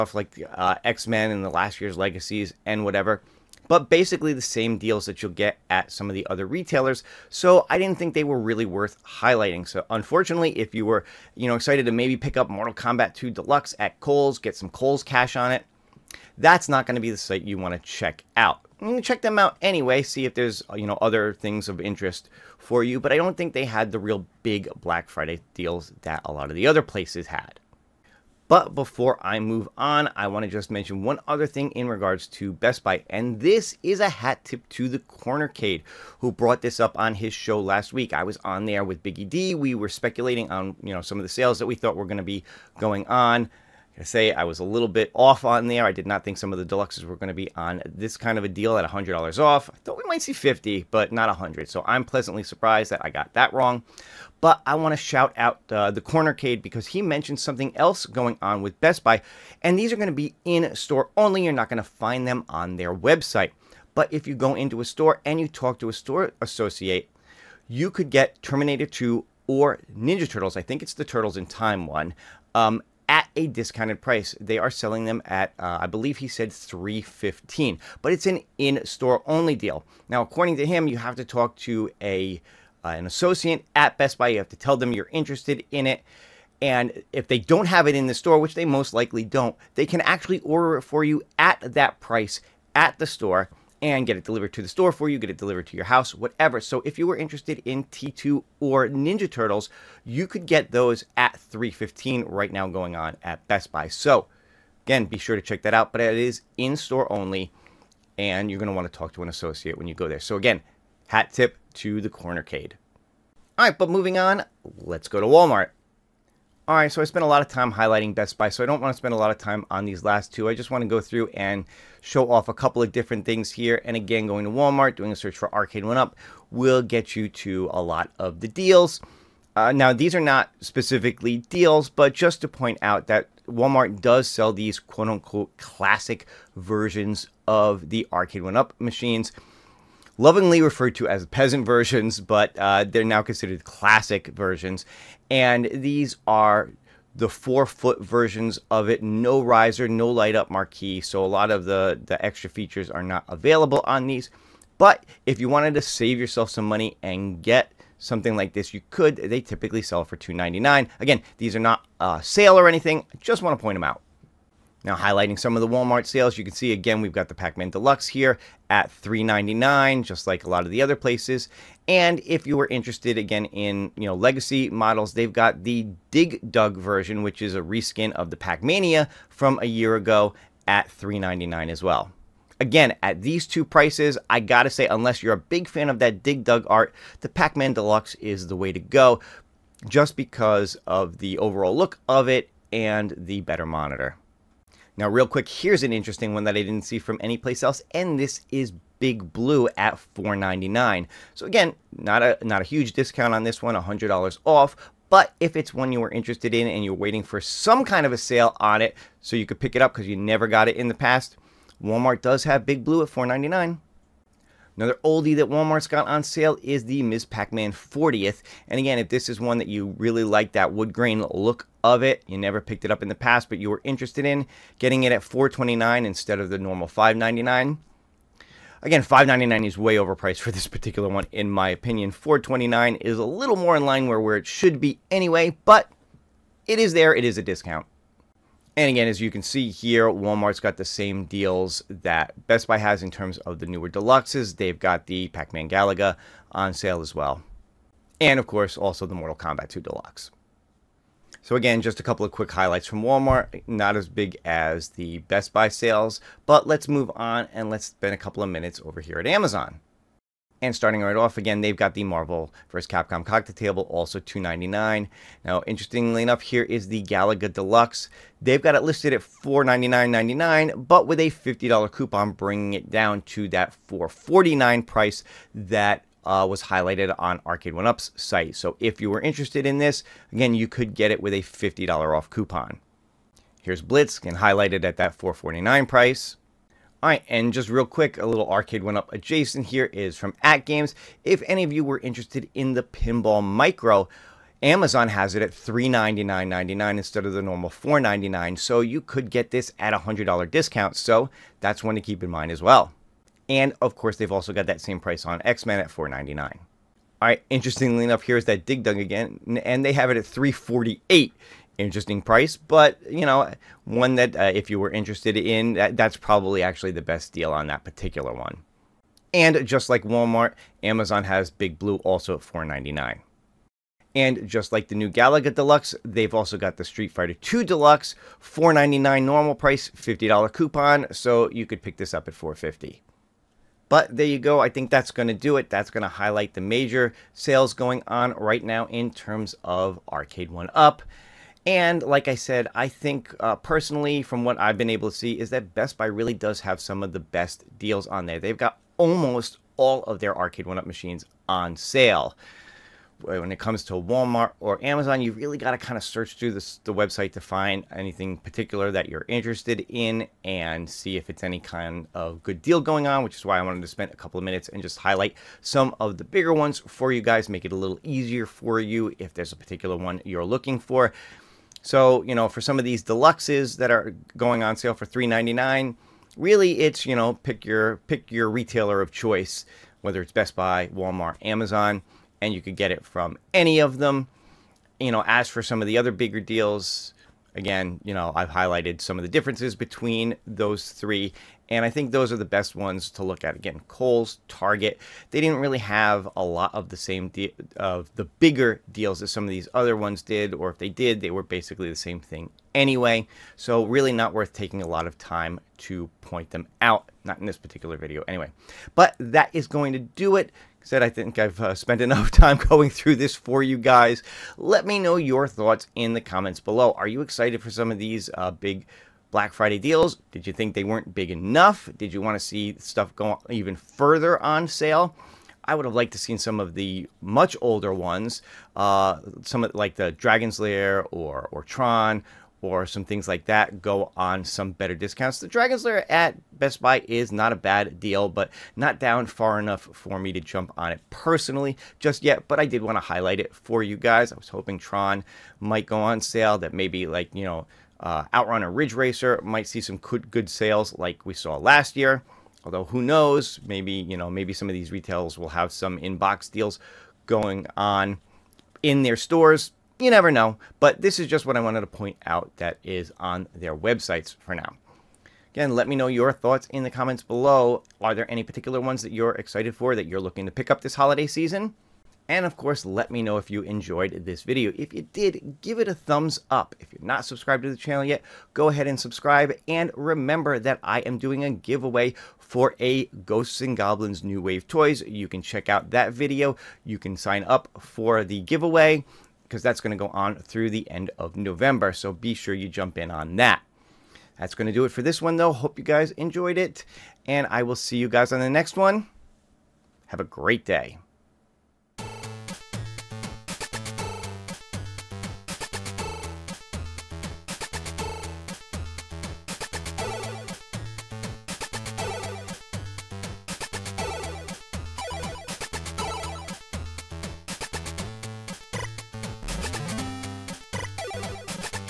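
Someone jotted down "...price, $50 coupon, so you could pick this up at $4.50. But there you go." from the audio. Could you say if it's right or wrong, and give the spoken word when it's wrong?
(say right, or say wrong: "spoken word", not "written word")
right.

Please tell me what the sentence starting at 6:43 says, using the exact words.
So really not worth taking a lot of time to point them out.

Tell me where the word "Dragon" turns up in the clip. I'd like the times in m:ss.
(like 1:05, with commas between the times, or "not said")
7:10, 7:15.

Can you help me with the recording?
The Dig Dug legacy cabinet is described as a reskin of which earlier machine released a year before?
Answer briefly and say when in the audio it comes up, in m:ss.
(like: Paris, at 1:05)
Pac-Mania, at 2:58.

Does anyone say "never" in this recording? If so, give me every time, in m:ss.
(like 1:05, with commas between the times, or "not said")
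3:30, 3:42, 7:40.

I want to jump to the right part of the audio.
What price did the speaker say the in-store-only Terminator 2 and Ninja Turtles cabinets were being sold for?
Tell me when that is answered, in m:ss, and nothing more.
1:16.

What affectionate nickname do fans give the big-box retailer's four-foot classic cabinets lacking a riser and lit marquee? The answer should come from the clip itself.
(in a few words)
peasant versions.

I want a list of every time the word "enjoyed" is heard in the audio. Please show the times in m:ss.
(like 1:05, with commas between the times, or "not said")
7:53, 8:16.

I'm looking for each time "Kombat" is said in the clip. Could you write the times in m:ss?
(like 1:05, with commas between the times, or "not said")
0:12, 4:09.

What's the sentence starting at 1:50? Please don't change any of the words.
So again, hat tip to the Cornercade.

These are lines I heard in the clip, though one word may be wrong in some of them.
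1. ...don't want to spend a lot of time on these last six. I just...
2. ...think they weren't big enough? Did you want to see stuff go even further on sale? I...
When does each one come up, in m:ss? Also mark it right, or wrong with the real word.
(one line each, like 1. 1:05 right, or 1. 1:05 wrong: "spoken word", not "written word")
1. 1:58 wrong: "two", not "six"
2. 7:00 right.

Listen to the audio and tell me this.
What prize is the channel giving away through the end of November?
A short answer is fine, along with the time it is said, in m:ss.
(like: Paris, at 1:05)
Ghosts and Goblins New Wave Toys, at 8:03.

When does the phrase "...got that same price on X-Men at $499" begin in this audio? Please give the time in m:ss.
5:04.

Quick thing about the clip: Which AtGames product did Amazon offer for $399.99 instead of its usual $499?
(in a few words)
Pinball Micro.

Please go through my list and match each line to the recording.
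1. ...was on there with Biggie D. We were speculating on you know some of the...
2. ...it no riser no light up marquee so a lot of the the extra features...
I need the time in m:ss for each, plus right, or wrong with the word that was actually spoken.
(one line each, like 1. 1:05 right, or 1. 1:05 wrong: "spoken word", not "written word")
1. 0:38 right
2. 2:28 right.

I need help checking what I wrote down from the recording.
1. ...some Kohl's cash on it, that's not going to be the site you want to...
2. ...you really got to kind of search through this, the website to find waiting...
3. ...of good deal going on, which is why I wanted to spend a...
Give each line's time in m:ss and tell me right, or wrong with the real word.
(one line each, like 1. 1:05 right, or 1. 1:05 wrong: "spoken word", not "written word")
1. 0:14 right
2. 5:55 wrong: "anything", not "waiting"
3. 6:02 right.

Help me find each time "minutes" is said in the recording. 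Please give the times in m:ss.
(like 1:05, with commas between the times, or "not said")
4:18, 6:04.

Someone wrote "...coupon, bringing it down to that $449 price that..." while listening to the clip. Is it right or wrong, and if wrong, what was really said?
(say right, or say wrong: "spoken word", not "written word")
right.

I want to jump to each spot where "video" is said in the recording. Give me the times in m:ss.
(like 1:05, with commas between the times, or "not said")
6:47, 7:54, 8:06.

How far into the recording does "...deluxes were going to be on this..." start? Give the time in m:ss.
0:46.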